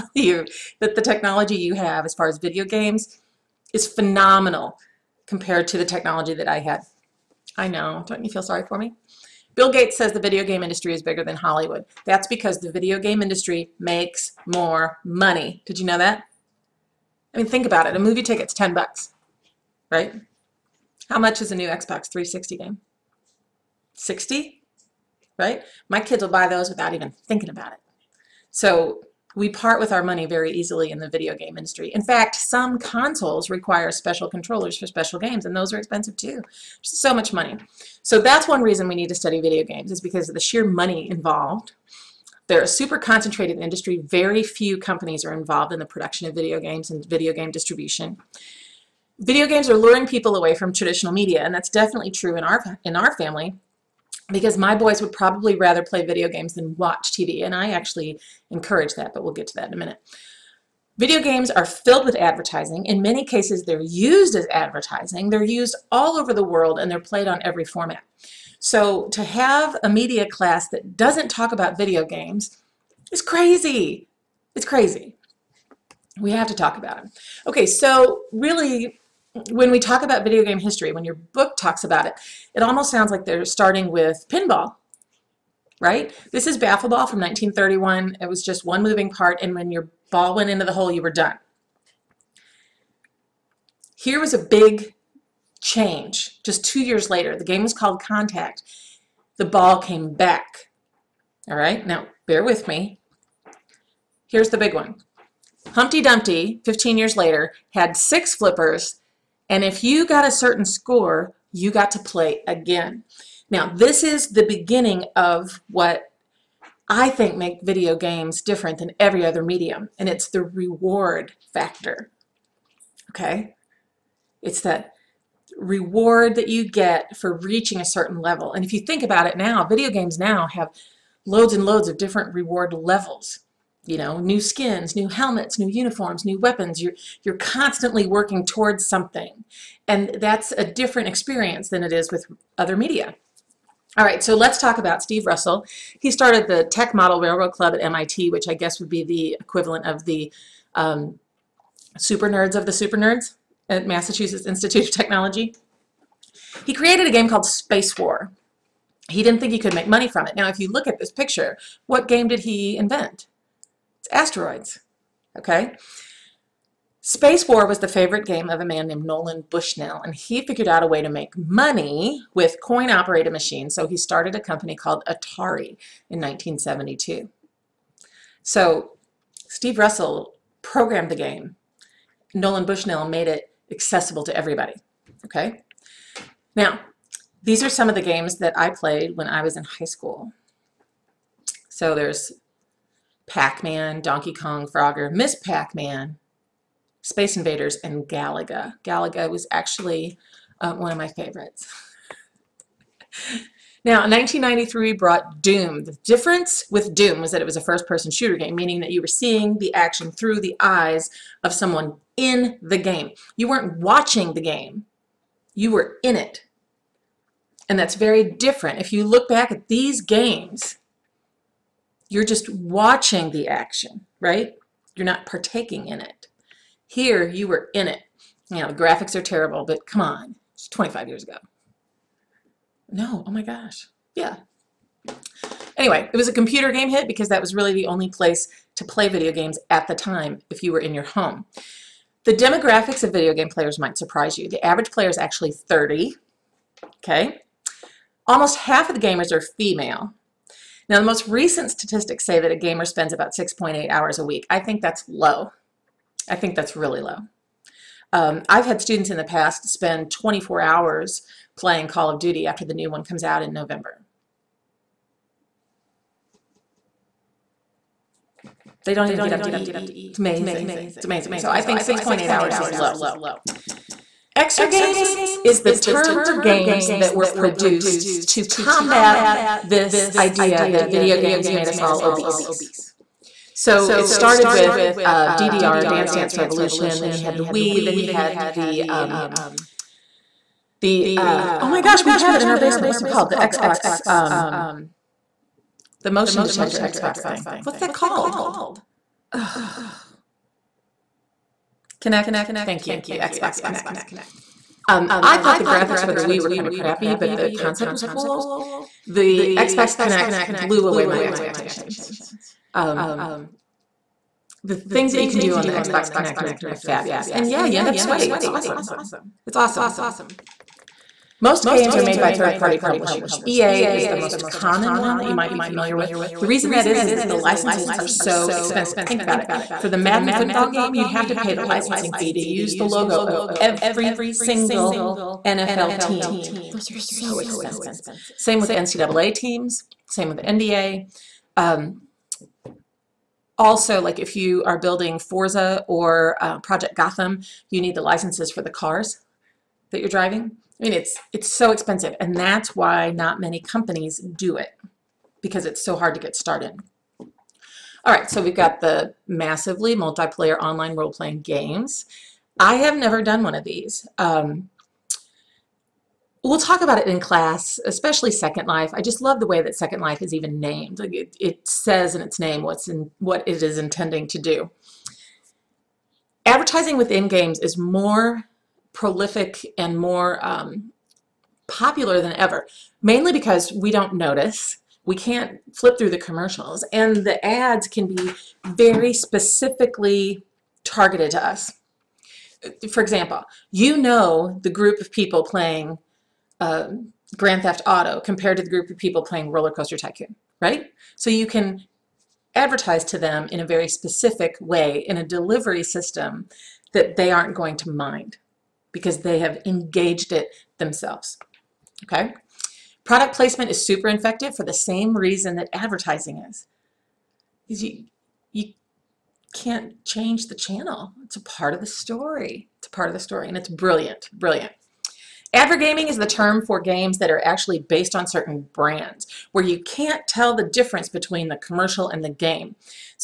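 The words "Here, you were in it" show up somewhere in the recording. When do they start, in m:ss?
3:46.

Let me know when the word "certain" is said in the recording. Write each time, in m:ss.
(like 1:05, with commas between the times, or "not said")
1:50, 2:07, 7:08.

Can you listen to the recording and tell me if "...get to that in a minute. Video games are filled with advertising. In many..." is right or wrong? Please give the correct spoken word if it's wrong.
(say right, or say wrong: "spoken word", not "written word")
right.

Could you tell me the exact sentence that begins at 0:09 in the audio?
Bill Gates says the video game industry is bigger than Hollywood.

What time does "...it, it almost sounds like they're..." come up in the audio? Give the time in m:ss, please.
1:22.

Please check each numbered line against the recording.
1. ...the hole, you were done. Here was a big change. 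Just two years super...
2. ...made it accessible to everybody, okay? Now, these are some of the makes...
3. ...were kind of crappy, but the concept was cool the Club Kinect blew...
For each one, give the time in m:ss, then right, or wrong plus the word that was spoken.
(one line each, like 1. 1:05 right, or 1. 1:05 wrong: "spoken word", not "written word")
1. 1:30 wrong: "later", not "super"
2. 3:03 wrong: "games", not "makes"
3. 5:06 wrong: "Xbox", not "Club".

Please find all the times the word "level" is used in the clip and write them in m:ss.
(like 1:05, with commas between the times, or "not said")
2:08, 2:12.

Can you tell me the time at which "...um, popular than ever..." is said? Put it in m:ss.
6:20.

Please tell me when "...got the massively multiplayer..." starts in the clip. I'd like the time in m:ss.
5:58.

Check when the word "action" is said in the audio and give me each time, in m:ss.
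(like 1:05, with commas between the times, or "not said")
3:29, 3:43.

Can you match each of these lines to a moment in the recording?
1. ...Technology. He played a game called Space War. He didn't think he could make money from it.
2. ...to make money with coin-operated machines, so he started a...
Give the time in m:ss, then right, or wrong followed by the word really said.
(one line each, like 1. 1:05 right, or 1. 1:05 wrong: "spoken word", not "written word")
1. 2:34 wrong: "created", not "played"
2. 2:51 right.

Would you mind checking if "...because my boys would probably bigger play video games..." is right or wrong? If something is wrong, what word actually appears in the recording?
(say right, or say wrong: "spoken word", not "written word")
wrong: "rather", not "bigger".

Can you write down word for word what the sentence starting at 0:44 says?
Very few companies are involved in the production of video games and video game distribution.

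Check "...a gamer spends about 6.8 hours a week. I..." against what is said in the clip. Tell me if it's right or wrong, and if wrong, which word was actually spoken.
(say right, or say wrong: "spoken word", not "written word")
right.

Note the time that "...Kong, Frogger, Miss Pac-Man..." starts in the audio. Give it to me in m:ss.
3:14.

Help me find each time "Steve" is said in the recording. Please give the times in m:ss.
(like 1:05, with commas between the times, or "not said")
2:25, 2:59.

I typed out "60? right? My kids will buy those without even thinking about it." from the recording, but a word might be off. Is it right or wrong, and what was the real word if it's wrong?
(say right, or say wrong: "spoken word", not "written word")
right.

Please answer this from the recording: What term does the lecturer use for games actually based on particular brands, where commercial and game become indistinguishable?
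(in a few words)
Advergaming.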